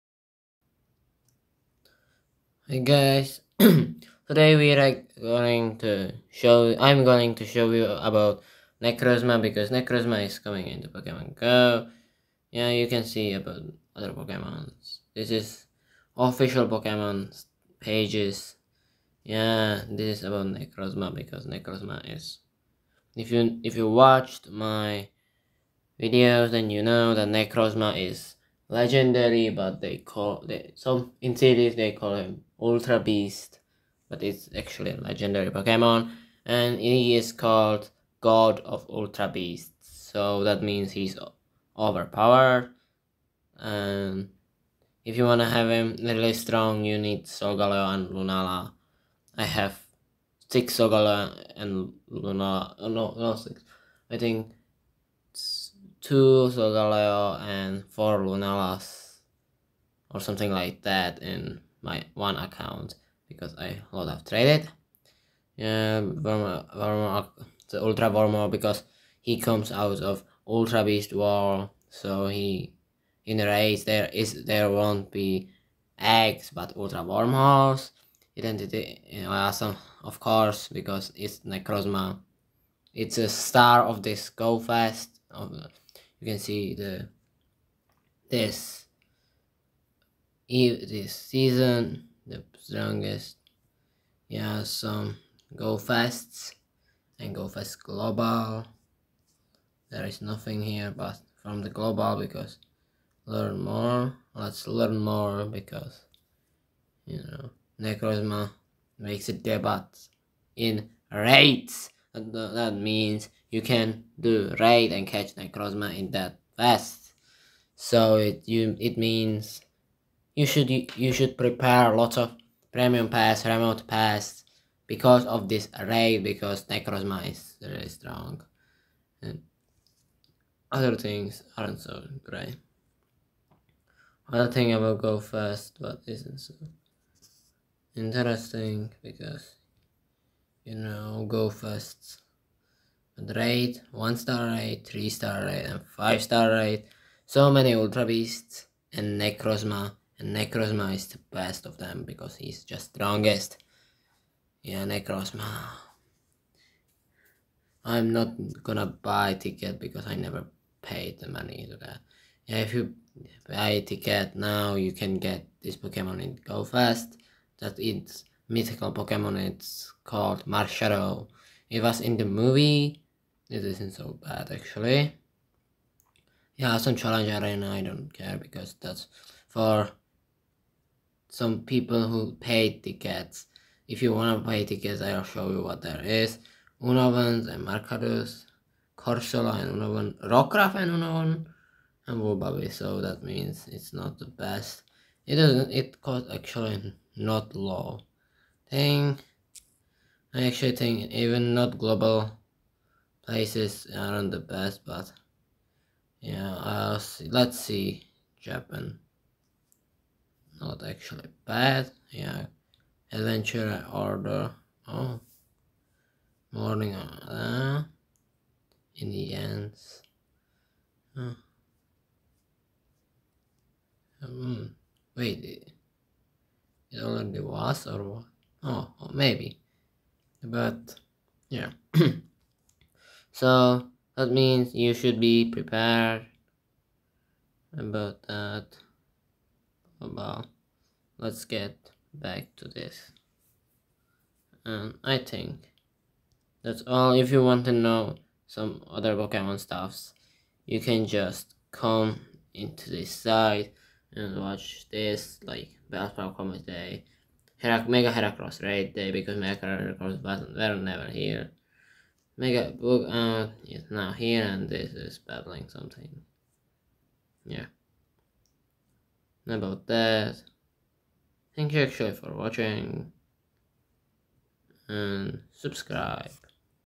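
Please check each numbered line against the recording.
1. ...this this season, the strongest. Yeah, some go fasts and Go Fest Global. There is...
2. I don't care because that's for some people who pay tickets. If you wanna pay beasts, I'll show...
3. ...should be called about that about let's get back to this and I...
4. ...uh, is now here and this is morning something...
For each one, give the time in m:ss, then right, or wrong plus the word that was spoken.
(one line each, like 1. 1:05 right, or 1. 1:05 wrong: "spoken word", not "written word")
1. 1:28 right
2. 2:57 wrong: "tickets", not "beasts"
3. 3:54 wrong: "prepared", not "called"
4. 4:23 wrong: "battling", not "morning".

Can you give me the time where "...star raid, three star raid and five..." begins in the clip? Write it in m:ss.
2:24.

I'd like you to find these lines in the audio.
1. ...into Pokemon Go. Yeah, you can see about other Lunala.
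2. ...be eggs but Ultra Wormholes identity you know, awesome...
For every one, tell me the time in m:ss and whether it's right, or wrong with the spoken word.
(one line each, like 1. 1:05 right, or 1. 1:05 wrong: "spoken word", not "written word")
1. 0:10 wrong: "Pokemons", not "Lunala"
2. 1:15 right.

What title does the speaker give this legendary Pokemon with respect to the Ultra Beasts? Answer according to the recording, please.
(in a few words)
God of Ultra Beasts.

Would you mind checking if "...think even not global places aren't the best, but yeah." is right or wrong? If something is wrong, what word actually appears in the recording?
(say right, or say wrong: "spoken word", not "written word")
right.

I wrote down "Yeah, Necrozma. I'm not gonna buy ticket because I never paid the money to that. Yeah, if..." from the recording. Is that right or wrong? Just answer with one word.
right.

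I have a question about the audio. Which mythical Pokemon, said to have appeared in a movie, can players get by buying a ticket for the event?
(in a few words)
Marshadow.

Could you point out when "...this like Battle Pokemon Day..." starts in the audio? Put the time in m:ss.
4:14.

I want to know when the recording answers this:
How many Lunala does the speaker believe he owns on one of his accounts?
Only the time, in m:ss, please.
0:57.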